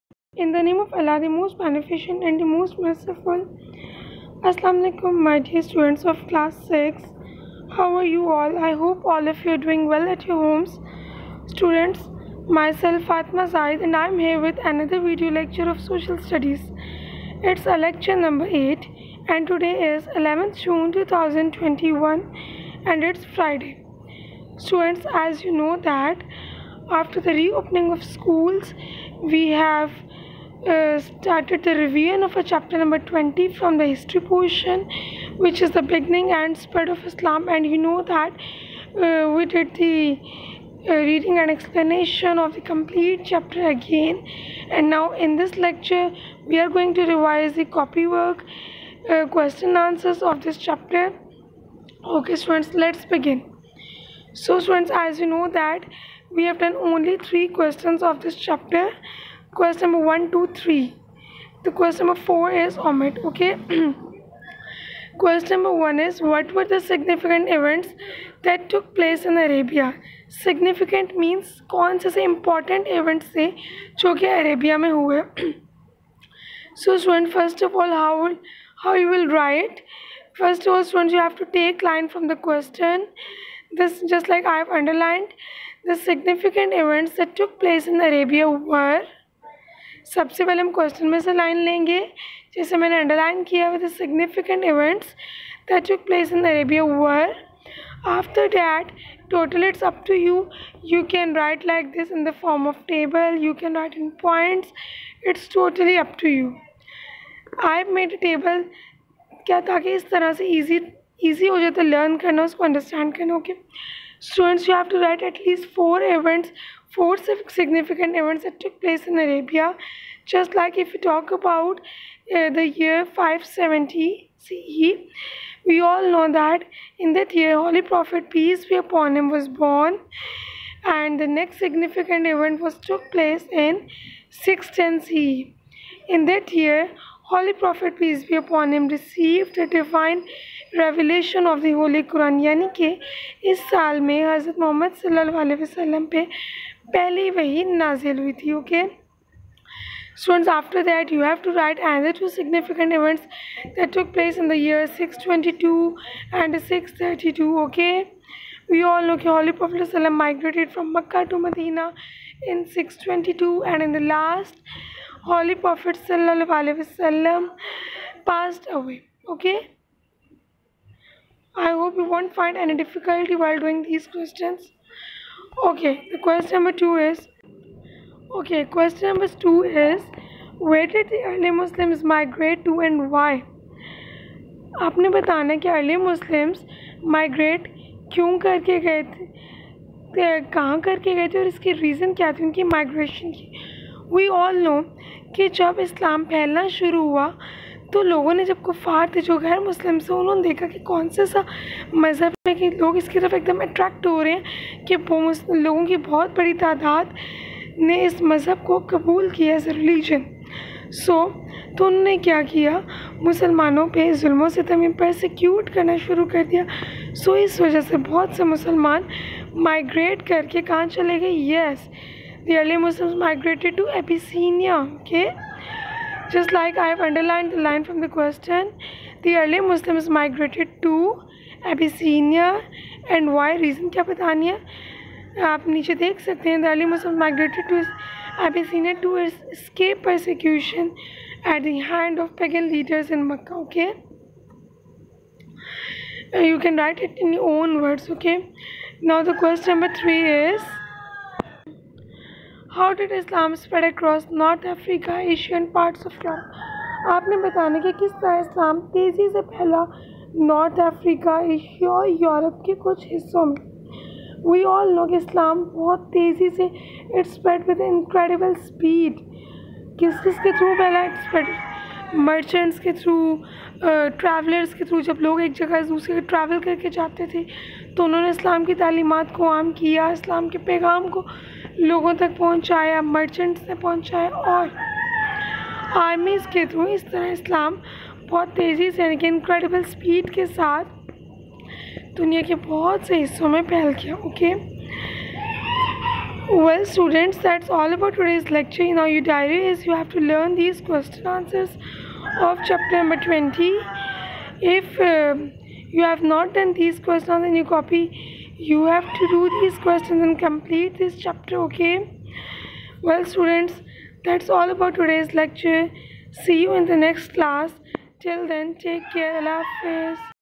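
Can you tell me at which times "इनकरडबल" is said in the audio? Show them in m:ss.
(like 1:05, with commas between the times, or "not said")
4:27, 4:49.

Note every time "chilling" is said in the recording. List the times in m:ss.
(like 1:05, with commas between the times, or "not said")
not said.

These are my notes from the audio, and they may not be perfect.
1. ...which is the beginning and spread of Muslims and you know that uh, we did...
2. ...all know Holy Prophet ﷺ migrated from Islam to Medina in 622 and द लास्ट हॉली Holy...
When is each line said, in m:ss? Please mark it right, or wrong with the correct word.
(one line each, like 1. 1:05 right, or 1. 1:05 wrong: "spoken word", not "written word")
1. 0:35 wrong: "Islam", not "Muslims"
2. 2:38 wrong: "Mecca", not "Islam".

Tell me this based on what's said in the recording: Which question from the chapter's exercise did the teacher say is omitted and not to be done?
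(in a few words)
Question 4.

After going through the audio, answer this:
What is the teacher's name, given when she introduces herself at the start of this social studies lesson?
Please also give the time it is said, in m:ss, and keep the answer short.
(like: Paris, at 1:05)
Fatma Zaid, at 0:13.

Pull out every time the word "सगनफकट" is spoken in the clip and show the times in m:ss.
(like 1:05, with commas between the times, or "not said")
1:33, 2:32.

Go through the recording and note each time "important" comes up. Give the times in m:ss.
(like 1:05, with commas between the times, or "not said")
1:12.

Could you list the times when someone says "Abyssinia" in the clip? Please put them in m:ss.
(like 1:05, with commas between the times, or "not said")
3:51, 3:58.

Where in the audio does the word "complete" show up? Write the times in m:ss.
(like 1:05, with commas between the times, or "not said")
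0:42, 5:10.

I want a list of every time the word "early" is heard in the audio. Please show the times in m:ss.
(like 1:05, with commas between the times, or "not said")
3:01, 3:49.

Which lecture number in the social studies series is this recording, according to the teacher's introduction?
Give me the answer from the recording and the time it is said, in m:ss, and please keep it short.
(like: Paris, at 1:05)
8, at 0:17.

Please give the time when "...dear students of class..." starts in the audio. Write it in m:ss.
0:05.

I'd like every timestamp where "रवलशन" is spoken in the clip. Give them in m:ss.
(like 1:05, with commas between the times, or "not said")
2:20.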